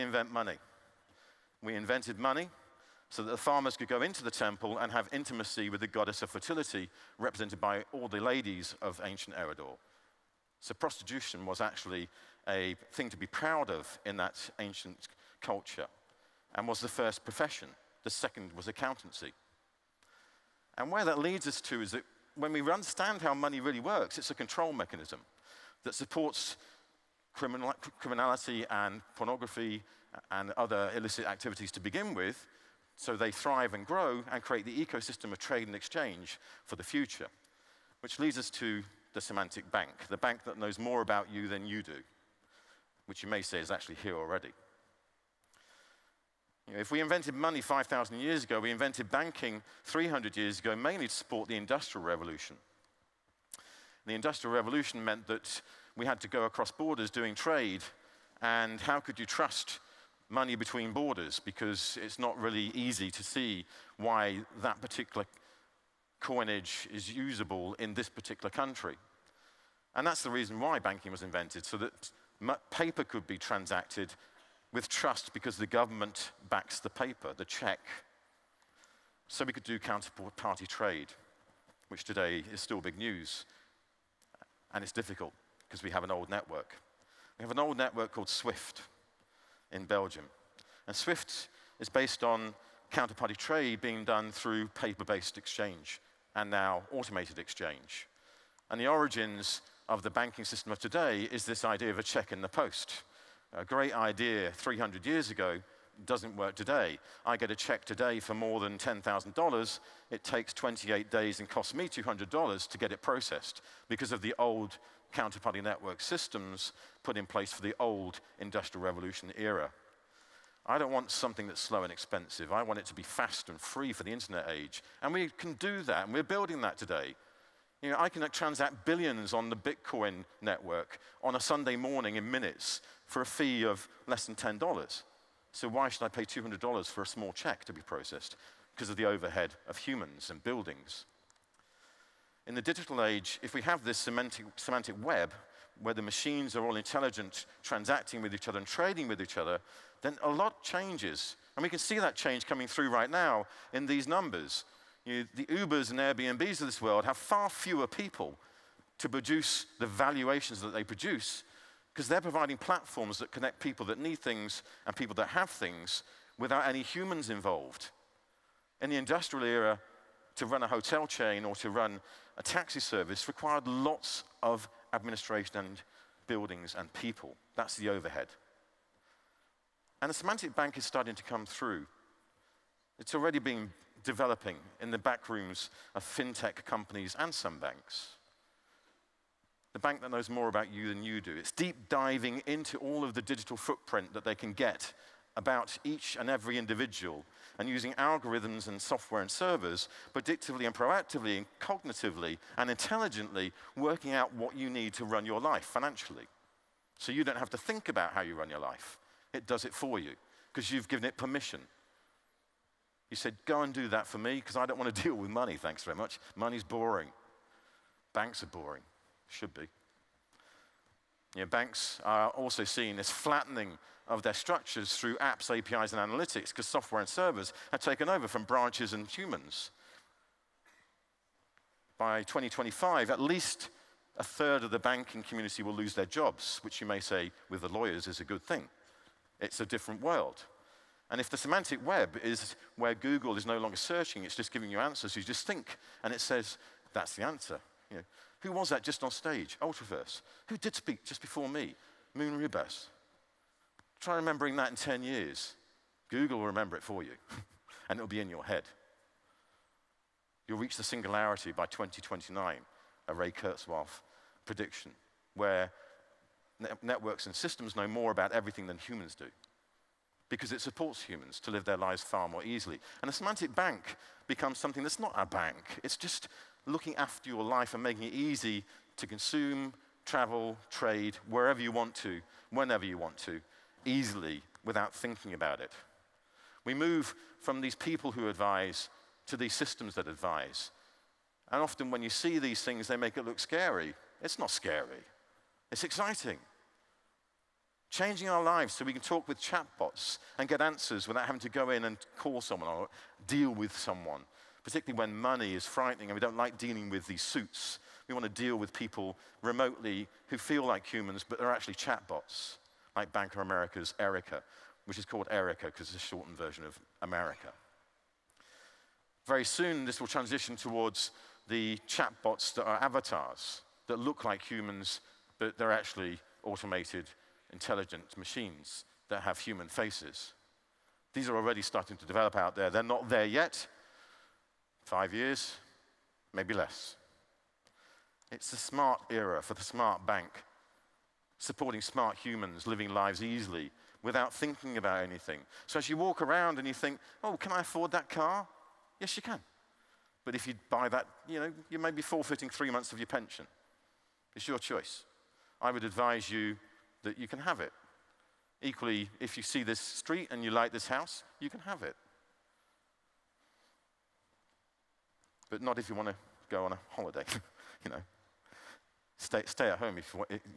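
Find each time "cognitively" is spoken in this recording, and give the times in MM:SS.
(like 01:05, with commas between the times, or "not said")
03:21.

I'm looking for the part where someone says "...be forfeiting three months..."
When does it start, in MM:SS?
05:51.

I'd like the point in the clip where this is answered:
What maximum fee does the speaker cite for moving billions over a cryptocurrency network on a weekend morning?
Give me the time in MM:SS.
02:14.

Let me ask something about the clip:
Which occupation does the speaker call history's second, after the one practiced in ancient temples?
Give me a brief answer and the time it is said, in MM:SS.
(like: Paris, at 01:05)
Accountancy, at 00:18.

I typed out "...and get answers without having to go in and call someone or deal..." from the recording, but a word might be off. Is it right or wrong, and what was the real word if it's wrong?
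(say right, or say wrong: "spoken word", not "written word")
right.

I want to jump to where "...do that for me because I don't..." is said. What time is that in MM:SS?
03:33.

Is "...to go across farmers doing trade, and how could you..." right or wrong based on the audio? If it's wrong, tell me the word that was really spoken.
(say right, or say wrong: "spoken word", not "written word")
wrong: "borders", not "farmers".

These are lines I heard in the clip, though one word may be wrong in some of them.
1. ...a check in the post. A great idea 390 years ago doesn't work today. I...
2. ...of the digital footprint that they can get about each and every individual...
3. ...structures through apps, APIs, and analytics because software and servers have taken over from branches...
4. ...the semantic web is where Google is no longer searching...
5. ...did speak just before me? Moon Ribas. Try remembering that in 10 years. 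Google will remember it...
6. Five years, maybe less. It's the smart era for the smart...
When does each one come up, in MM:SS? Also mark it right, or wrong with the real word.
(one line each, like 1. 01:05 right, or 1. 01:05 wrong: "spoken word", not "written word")
1. 01:41 wrong: "300", not "390"
2. 03:13 right
3. 03:44 right
4. 04:01 right
5. 04:10 right
6. 05:34 right.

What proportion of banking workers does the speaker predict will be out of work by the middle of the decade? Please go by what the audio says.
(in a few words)
A third.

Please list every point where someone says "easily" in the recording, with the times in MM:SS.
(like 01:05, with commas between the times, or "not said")
04:32, 04:43, 05:43.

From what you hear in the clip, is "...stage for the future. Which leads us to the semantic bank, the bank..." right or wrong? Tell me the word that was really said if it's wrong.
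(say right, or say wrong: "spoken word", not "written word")
wrong: "exchange", not "stage".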